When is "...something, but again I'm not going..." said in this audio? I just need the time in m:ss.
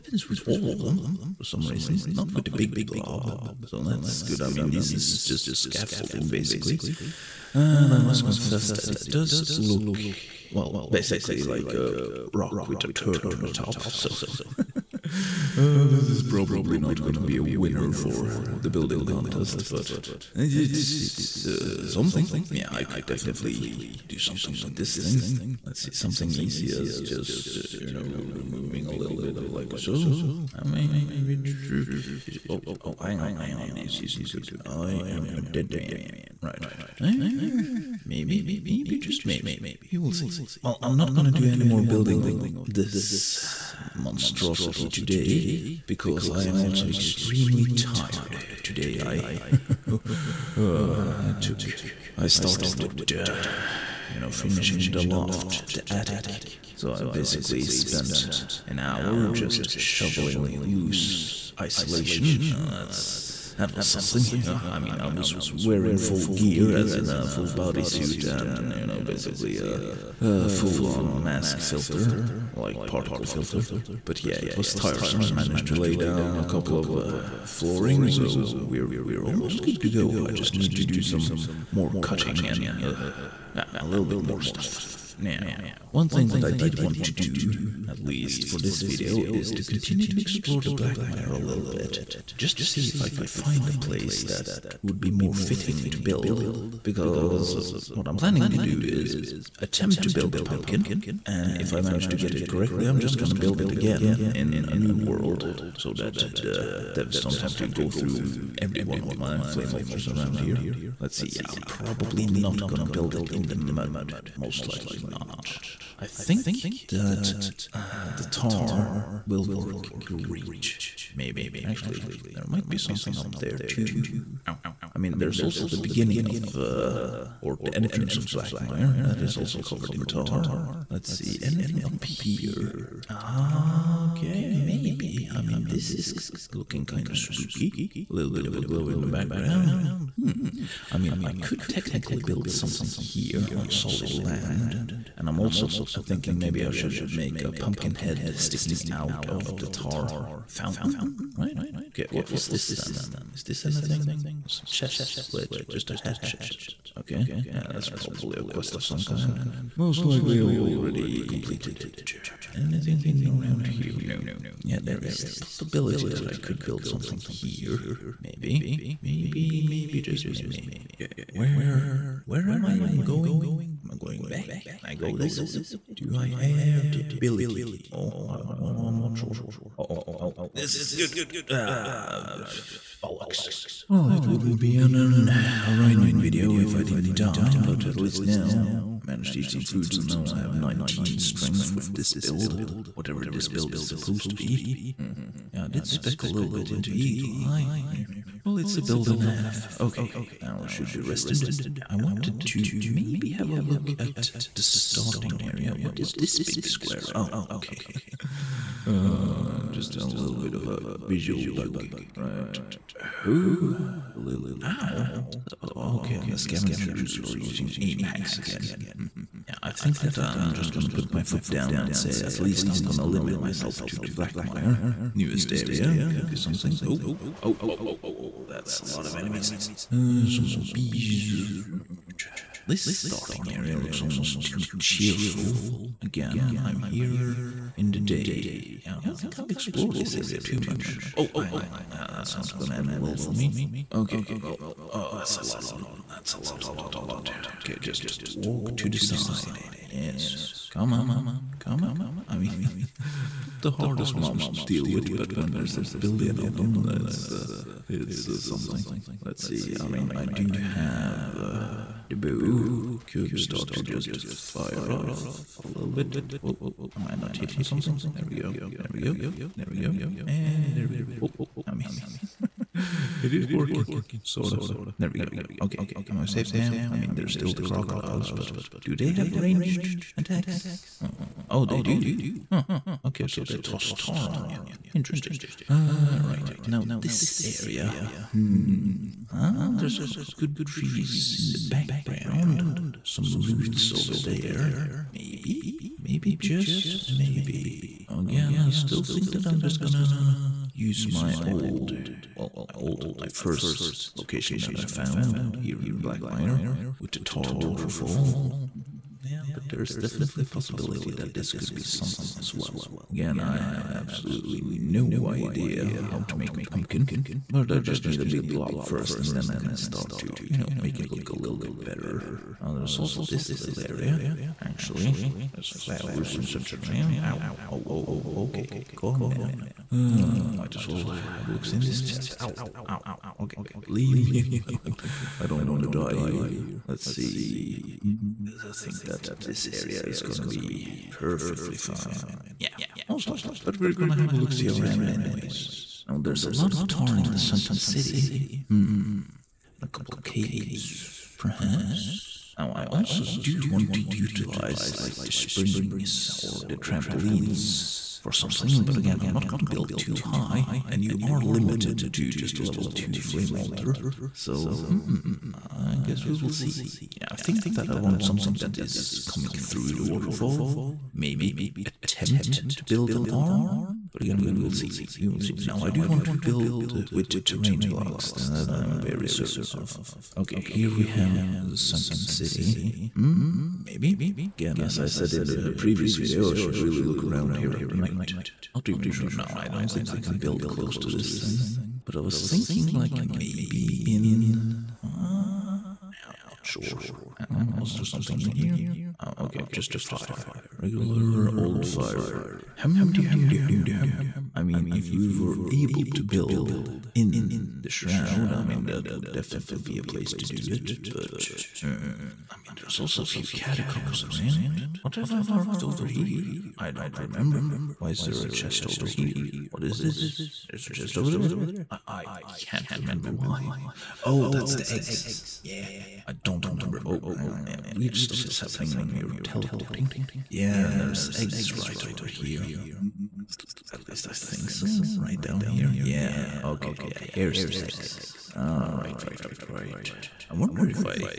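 5:58.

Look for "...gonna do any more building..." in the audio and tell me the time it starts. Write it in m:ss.
0:41.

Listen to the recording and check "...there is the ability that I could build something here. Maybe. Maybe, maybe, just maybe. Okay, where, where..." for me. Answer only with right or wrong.
wrong.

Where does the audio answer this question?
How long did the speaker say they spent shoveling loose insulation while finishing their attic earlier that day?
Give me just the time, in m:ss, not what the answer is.
0:58.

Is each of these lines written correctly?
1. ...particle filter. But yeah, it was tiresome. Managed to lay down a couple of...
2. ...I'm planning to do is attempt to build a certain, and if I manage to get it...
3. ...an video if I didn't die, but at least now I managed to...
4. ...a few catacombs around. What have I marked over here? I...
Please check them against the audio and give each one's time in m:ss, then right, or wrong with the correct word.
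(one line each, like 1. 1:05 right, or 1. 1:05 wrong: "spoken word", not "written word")
1. 1:12 right
2. 1:38 wrong: "pumpkin", not "certain"
3. 3:04 right
4. 6:53 right.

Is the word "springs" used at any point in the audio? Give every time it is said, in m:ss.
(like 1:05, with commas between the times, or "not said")
5:55.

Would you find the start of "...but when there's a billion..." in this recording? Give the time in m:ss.
4:15.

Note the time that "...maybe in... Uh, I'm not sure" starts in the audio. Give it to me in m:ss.
6:33.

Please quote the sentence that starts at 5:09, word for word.
Yeah, but there's definitely a possibility that this could be something as well.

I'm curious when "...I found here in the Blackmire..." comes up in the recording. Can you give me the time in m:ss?
5:04.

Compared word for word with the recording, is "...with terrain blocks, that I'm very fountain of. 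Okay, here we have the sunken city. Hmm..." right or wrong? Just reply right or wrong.
wrong.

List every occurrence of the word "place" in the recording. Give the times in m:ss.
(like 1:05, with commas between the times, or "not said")
1:33, 6:50.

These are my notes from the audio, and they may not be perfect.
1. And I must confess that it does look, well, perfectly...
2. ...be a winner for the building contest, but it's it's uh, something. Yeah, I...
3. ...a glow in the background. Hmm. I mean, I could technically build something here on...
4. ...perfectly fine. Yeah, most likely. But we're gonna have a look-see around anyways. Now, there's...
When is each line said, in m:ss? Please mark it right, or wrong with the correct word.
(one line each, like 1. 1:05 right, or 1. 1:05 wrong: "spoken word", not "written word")
1. 0:07 wrong: "basically", not "perfectly"
2. 0:17 right
3. 2:18 right
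4. 5:41 right.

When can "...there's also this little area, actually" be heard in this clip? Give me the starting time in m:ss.
5:22.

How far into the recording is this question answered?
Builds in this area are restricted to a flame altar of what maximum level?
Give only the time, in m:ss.
6:02.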